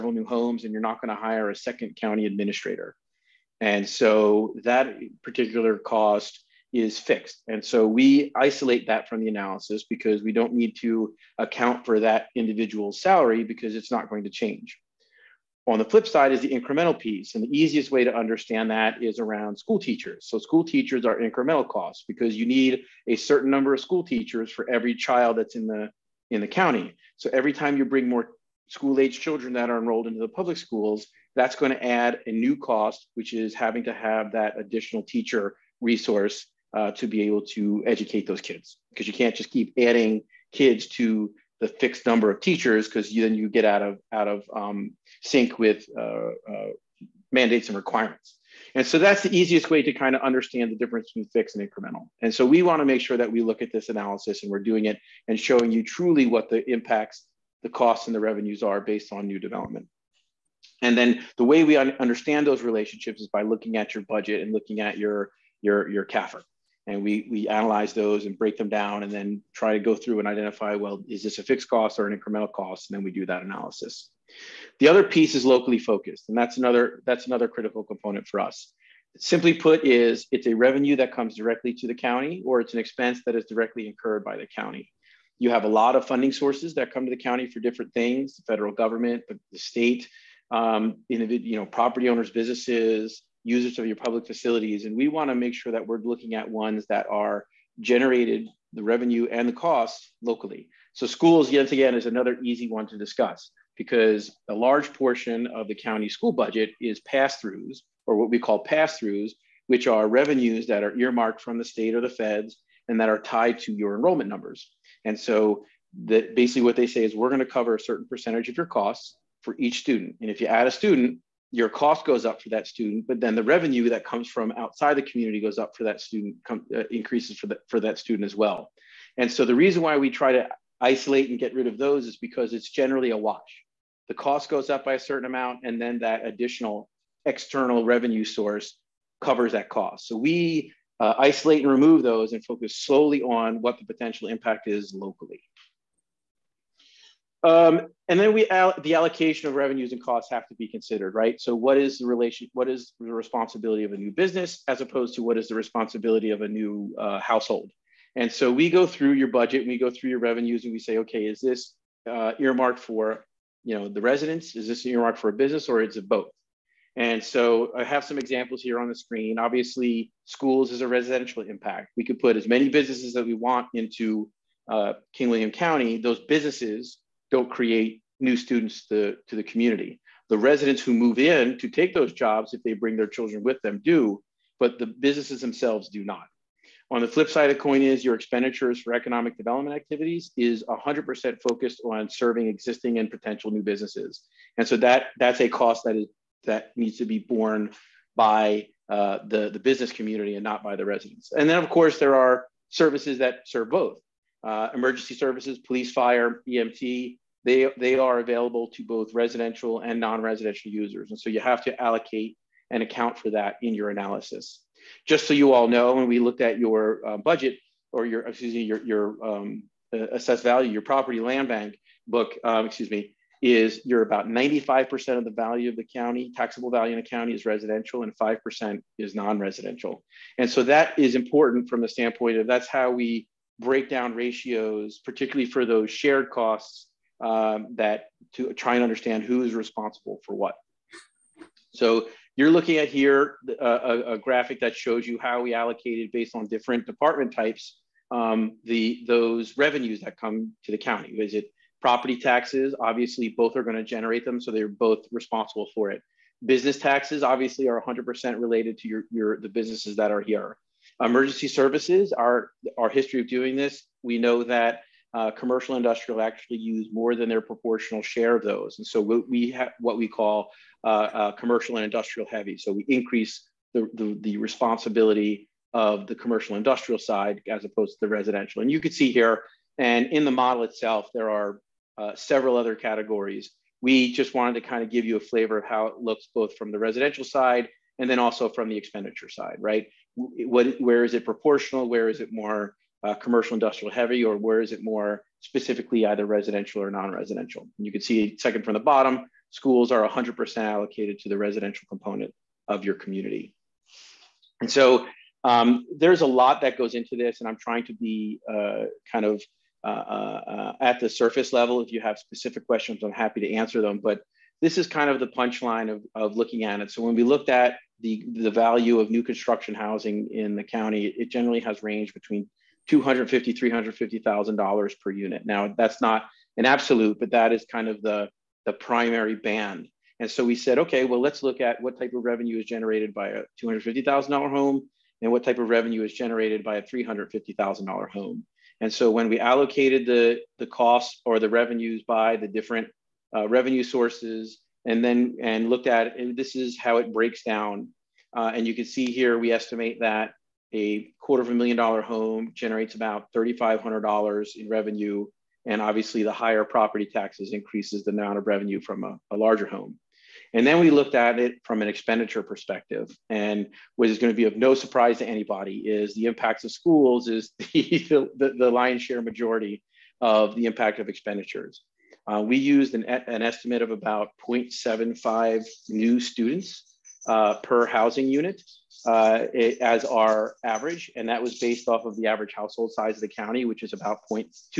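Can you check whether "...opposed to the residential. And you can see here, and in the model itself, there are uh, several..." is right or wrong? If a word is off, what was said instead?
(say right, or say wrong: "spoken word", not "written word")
right.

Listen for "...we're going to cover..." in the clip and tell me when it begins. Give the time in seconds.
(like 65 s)
117 s.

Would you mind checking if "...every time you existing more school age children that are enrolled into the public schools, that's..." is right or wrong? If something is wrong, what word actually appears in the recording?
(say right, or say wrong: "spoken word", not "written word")
wrong: "bring", not "existing".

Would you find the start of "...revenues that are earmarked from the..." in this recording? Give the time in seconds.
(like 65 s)
110 s.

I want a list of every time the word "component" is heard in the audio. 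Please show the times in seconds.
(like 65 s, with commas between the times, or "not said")
77 s, 301 s.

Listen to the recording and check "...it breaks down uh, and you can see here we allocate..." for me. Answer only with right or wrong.
wrong.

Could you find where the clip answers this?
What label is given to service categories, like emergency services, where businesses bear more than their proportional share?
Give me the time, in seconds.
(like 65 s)
271 s.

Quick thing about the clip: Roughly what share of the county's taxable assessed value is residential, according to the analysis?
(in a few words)
95%.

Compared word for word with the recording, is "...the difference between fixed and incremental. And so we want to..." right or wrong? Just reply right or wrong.
right.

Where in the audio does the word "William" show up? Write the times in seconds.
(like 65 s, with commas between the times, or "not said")
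175 s.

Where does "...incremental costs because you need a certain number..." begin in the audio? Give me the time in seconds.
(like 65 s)
21 s.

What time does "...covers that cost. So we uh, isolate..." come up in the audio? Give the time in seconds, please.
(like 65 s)
139 s.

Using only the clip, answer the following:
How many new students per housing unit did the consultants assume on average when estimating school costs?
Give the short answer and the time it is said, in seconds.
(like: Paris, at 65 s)
0.75, at 374 s.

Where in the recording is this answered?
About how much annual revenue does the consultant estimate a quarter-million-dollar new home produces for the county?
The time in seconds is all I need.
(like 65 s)
353 s.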